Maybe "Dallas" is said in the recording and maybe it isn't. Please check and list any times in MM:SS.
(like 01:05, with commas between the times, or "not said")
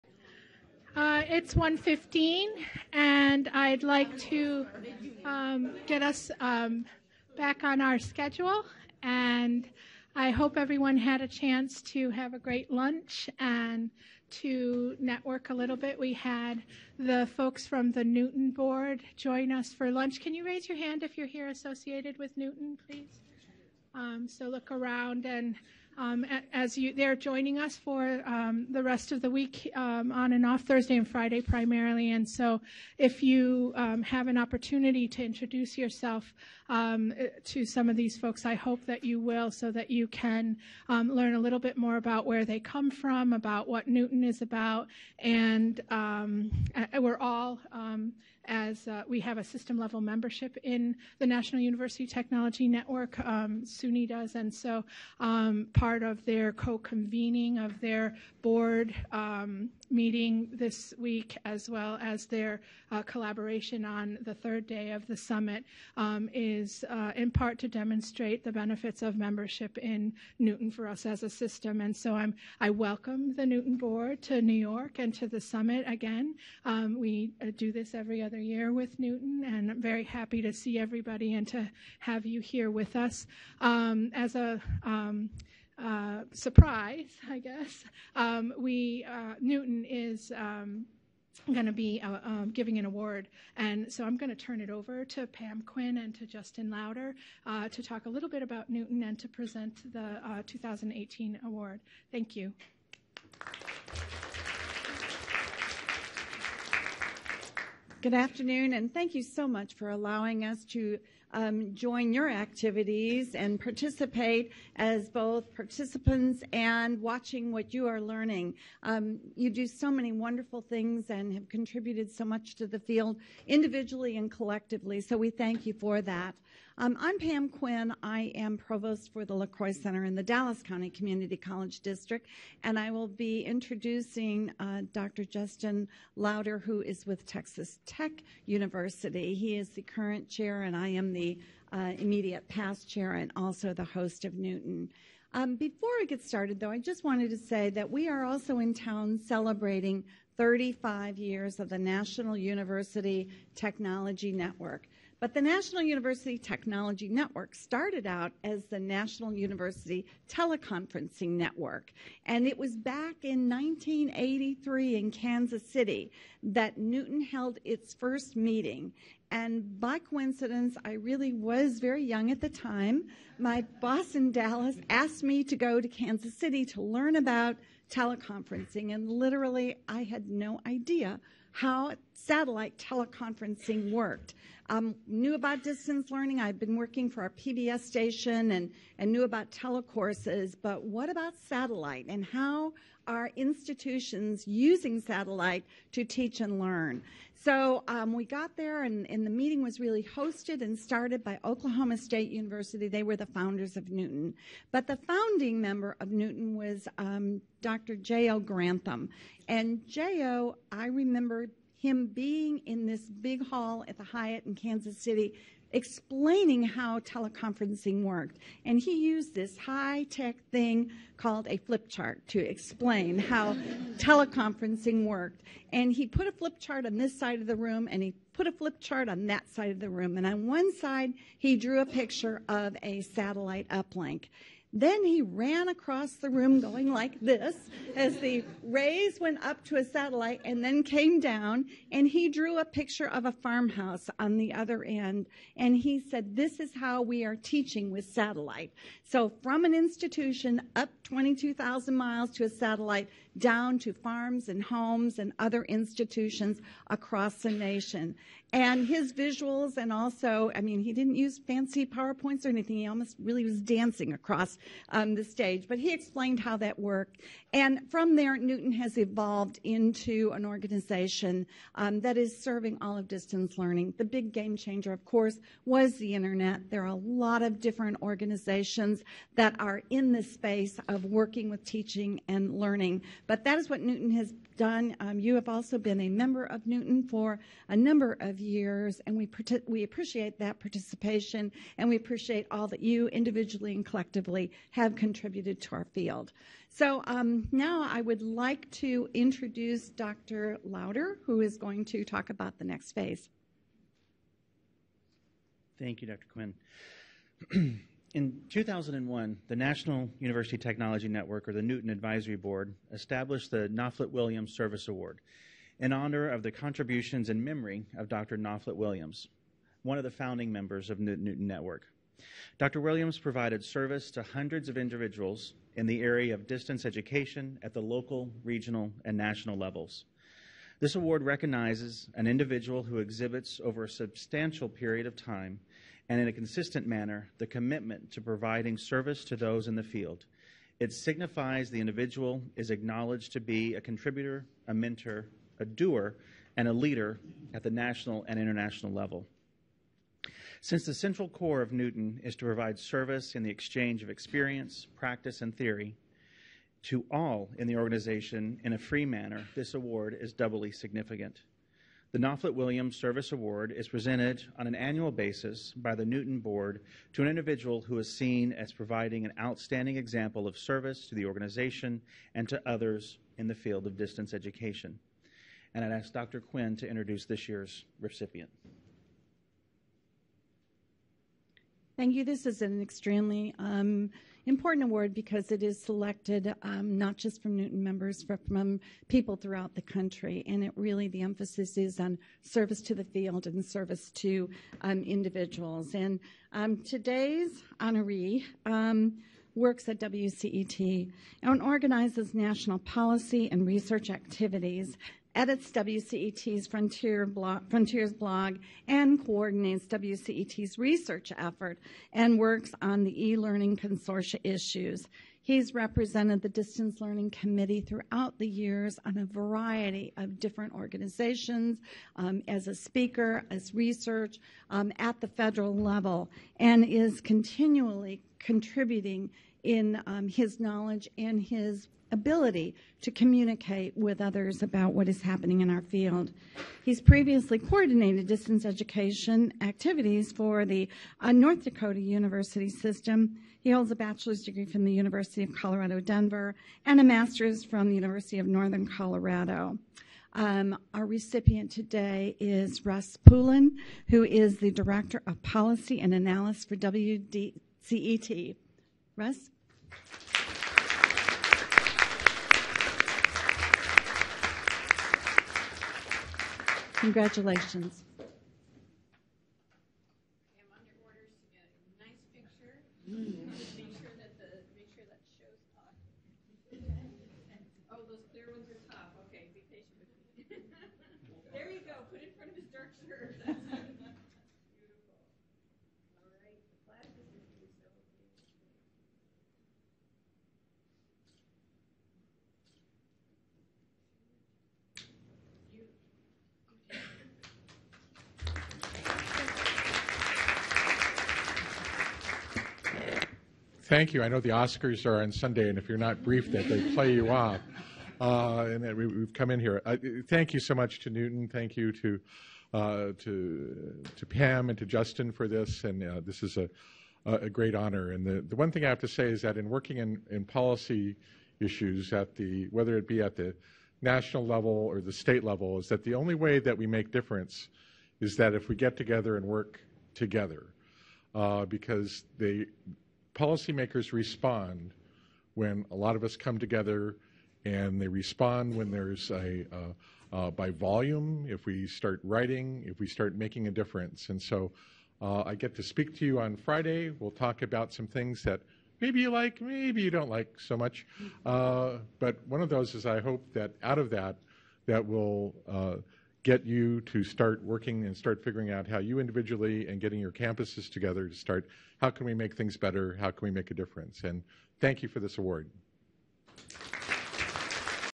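02:10, 02:54.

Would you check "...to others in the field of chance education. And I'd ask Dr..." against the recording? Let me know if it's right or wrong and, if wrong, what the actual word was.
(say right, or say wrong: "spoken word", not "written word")
wrong: "distance", not "chance".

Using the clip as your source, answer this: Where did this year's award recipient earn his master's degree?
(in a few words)
University of Northern Colorado.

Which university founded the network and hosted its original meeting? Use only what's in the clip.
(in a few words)
Oklahoma State University.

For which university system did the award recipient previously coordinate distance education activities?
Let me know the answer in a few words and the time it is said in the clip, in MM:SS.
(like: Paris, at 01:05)
North Dakota University system, at 07:21.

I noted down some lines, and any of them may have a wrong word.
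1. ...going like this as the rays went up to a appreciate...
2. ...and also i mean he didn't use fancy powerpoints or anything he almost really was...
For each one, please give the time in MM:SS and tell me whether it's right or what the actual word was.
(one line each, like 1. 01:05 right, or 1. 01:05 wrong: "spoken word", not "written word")
1. 03:56 wrong: "satellite", not "appreciate"
2. 04:19 right.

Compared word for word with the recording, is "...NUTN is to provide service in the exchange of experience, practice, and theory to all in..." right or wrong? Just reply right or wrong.
right.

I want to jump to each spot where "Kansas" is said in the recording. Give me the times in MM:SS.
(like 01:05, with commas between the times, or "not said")
02:45, 02:55, 03:34.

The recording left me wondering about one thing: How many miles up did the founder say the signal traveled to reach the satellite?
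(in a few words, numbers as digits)
22,000.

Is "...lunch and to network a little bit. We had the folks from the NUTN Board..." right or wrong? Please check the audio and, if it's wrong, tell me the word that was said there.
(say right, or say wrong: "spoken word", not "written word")
right.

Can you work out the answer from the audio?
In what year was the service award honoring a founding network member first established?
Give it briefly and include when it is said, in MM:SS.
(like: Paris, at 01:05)
2001, at 05:08.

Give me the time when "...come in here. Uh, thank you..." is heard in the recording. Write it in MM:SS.
08:29.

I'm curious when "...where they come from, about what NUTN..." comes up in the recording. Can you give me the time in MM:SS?
00:42.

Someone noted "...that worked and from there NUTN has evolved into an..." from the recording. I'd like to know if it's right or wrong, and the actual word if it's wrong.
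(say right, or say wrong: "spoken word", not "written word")
right.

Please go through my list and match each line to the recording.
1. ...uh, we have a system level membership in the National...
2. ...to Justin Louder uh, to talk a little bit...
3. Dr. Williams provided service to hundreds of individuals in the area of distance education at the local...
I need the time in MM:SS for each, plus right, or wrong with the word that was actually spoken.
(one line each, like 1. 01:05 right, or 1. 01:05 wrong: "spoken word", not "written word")
1. 00:48 right
2. 01:36 right
3. 05:22 right.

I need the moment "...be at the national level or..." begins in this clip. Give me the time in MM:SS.
08:43.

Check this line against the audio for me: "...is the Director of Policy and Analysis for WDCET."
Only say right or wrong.
right.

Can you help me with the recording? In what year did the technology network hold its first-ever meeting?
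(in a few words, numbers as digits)
1983.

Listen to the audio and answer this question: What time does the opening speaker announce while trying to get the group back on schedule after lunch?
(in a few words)
1:15.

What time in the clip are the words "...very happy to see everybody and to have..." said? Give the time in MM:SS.
01:19.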